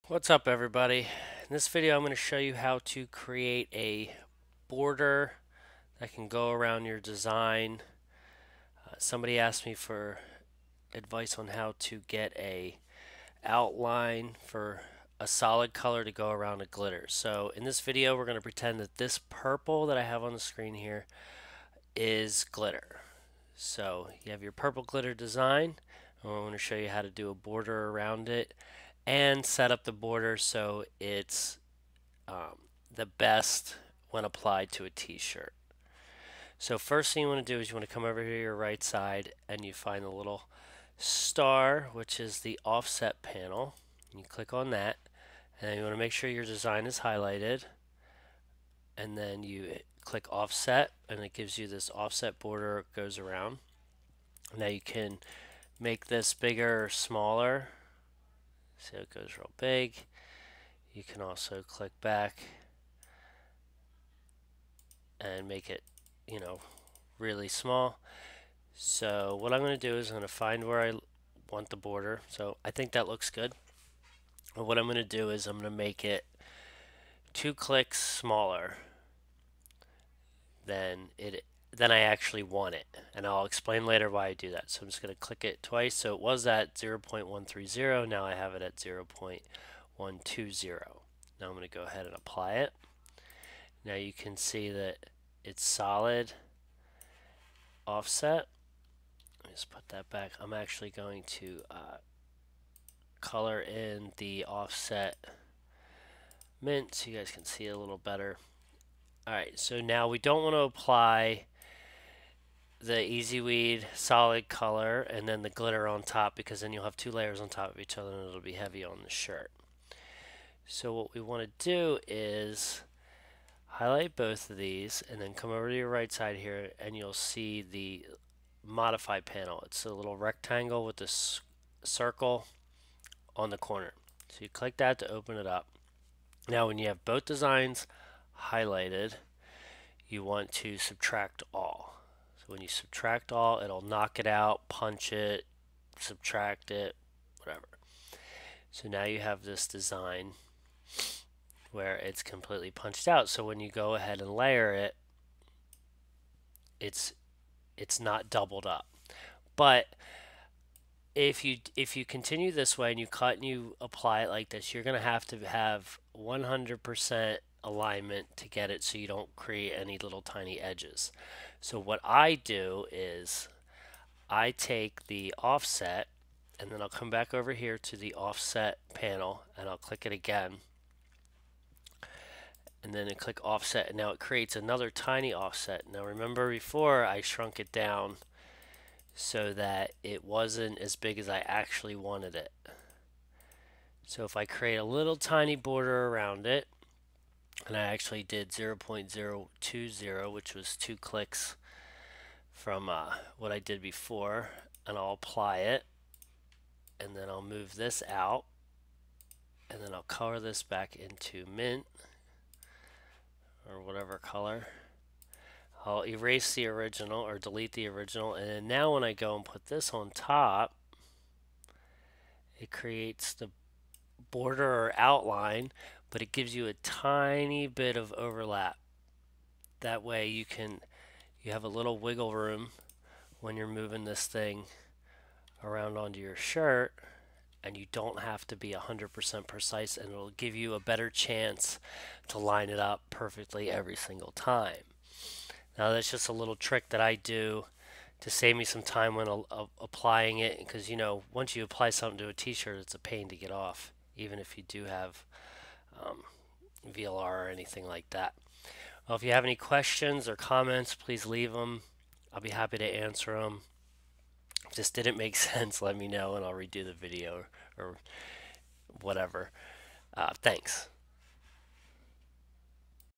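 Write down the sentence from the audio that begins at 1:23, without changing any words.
And I'll explain later why I do that.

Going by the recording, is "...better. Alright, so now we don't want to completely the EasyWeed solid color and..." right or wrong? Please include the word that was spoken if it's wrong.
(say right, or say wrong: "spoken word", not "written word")
wrong: "apply", not "completely".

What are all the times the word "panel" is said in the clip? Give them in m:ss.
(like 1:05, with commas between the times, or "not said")
0:43, 2:09, 2:58.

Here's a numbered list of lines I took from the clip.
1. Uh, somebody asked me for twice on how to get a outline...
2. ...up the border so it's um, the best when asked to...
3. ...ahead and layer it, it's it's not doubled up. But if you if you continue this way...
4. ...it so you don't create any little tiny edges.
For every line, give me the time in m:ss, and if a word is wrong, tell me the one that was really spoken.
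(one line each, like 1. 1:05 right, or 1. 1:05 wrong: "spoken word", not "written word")
1. 0:08 wrong: "advice", not "twice"
2. 0:29 wrong: "applied", not "asked"
3. 2:33 right
4. 2:48 right.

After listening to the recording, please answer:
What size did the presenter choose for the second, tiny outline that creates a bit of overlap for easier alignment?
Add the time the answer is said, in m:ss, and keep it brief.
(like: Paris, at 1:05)
0.020, at 3:18.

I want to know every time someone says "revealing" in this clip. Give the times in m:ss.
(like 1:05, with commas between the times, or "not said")
not said.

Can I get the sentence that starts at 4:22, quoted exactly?
I'll be happy to answer them.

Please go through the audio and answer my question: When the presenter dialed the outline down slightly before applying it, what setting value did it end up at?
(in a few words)
0.120.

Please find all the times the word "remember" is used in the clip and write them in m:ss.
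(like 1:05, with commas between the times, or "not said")
3:06.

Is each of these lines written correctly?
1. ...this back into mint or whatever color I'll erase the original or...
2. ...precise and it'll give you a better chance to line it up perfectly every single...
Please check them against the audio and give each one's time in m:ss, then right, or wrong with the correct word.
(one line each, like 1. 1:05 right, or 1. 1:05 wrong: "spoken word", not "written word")
1. 3:30 right
2. 3:59 right.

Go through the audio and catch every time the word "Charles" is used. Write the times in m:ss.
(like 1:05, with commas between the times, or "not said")
not said.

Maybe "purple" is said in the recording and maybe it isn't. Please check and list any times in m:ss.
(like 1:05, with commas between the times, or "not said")
0:19, 0:24.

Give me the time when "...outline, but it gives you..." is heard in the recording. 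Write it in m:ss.
3:44.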